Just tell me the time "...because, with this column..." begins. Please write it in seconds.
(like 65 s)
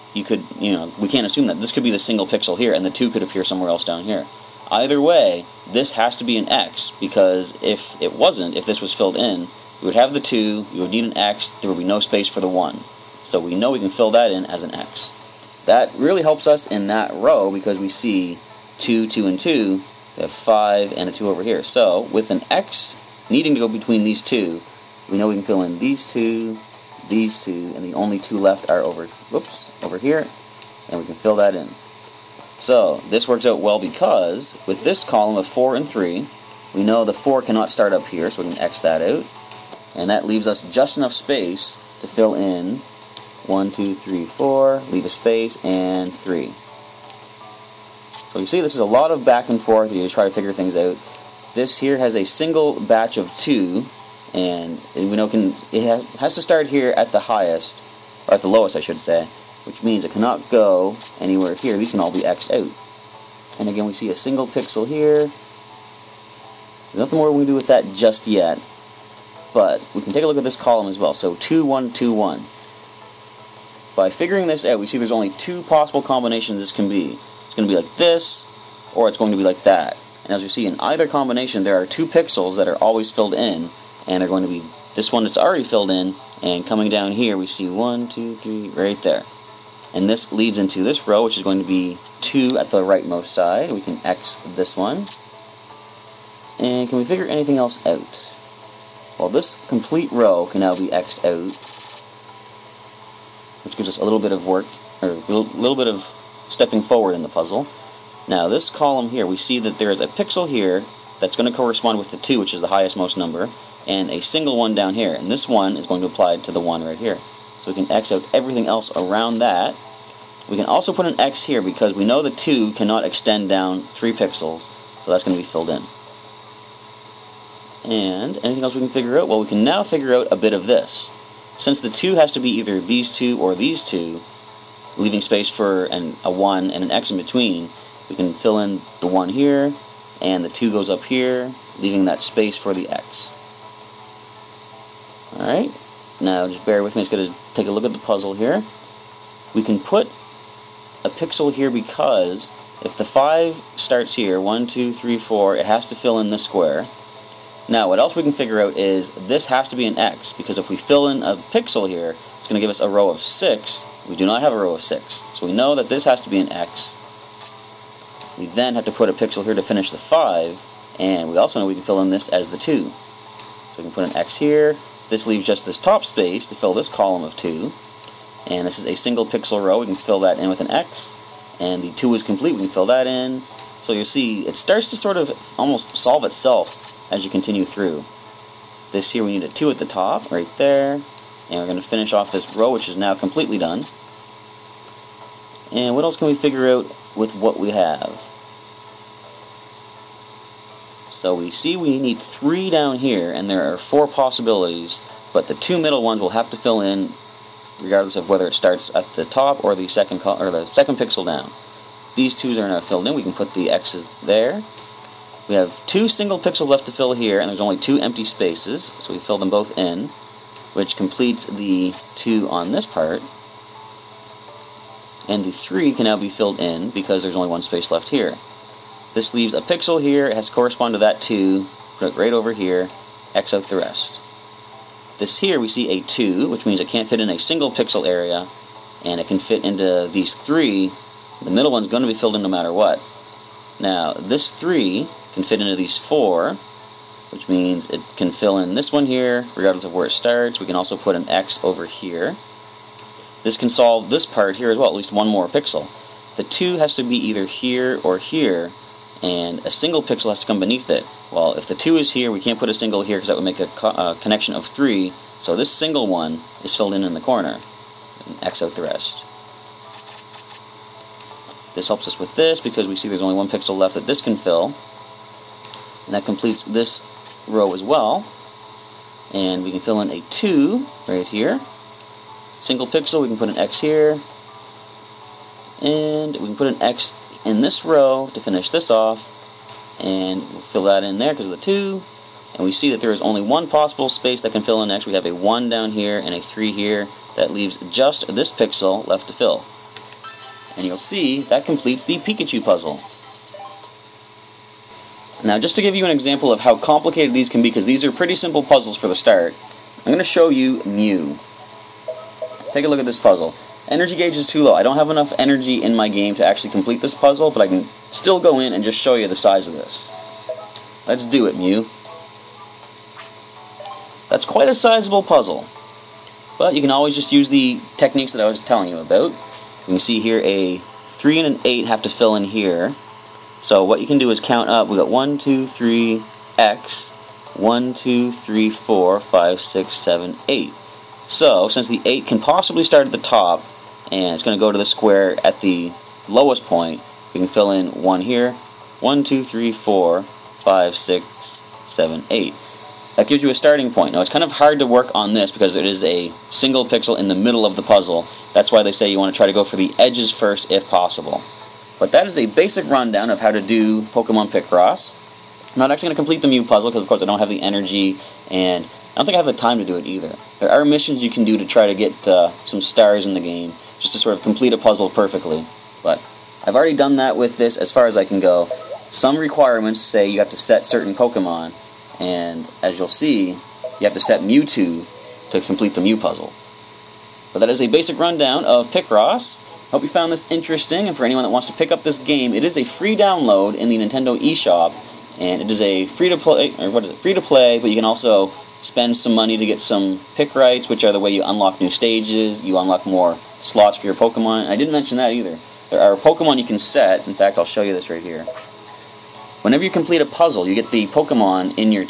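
33 s.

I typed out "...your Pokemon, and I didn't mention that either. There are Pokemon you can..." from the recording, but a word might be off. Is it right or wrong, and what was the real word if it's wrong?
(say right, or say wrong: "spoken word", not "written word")
right.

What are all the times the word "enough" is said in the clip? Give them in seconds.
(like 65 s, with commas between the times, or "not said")
40 s, 315 s.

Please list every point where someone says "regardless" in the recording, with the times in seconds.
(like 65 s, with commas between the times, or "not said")
207 s, 249 s.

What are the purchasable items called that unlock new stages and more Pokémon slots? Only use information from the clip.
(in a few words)
Picrites.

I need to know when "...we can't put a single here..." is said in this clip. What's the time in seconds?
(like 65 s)
262 s.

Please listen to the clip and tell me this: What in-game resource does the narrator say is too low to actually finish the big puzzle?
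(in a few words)
Energy gauge.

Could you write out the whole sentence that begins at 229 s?
This leaves a pixel here, it has to correspond to that 2, put right over here, X out the rest.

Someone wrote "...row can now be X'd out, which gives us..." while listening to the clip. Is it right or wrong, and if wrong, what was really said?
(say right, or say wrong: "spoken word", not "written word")
right.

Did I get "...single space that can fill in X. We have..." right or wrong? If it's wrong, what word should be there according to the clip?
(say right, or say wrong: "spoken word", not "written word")
wrong: "possible", not "single".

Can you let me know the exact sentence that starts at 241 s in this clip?
The middle one's going to be filled in no matter what.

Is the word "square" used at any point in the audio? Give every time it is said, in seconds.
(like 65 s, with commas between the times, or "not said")
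156 s, 344 s.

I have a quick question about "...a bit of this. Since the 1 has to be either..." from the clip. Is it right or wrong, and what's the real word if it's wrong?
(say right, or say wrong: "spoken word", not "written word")
wrong: "2", not "1".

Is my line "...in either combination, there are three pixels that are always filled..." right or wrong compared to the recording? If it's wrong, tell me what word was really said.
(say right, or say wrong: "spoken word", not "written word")
wrong: "two", not "three".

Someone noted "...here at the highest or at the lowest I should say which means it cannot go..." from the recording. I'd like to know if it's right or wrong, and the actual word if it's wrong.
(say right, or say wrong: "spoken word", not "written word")
right.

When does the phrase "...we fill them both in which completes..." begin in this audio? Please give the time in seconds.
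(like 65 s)
219 s.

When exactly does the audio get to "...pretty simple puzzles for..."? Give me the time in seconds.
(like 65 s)
308 s.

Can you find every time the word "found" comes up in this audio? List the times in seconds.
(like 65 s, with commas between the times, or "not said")
390 s.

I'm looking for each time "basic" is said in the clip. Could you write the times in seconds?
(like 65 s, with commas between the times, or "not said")
362 s, 387 s.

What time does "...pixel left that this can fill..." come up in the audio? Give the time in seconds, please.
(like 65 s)
273 s.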